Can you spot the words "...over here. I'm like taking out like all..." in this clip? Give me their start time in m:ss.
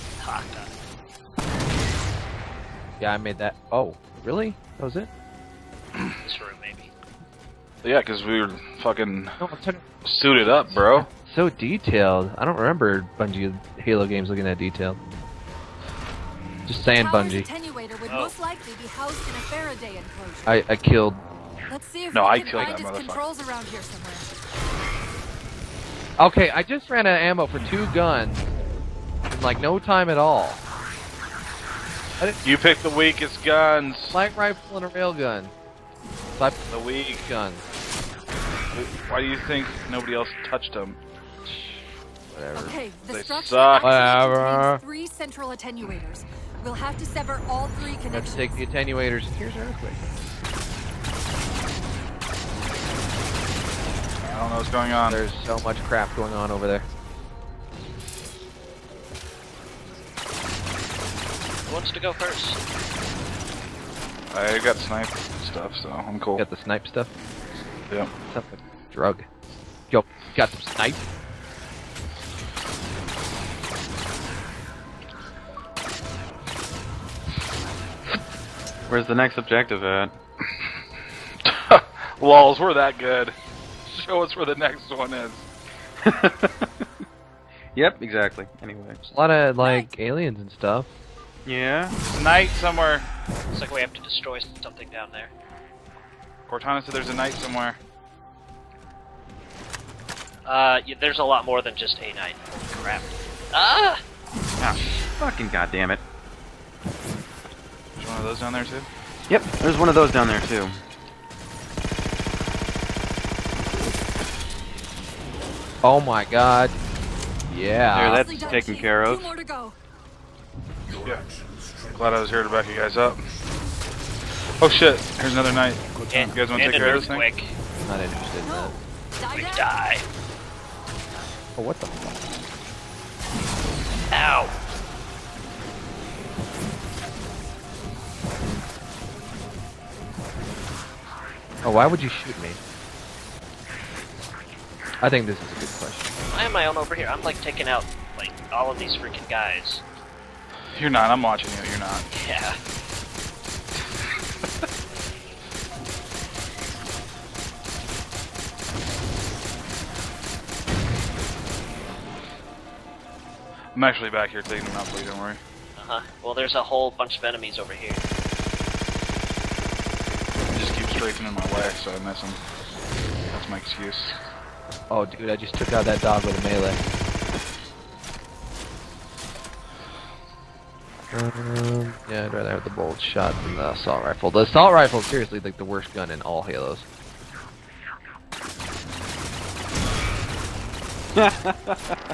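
2:26.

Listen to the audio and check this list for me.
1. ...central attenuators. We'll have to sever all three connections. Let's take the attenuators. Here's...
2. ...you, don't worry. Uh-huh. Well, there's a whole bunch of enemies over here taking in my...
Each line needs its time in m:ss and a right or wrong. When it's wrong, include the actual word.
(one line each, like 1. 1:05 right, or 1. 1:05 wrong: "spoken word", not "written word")
1. 0:45 right
2. 2:45 wrong: "streaking", not "taking".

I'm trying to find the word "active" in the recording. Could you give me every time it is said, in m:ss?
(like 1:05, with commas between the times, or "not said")
not said.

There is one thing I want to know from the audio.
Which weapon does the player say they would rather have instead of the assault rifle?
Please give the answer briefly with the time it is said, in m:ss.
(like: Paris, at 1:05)
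Bolt shot, at 3:02.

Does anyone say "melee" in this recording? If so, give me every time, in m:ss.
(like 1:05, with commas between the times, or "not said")
2:56.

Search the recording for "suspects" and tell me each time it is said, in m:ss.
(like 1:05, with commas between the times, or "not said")
not said.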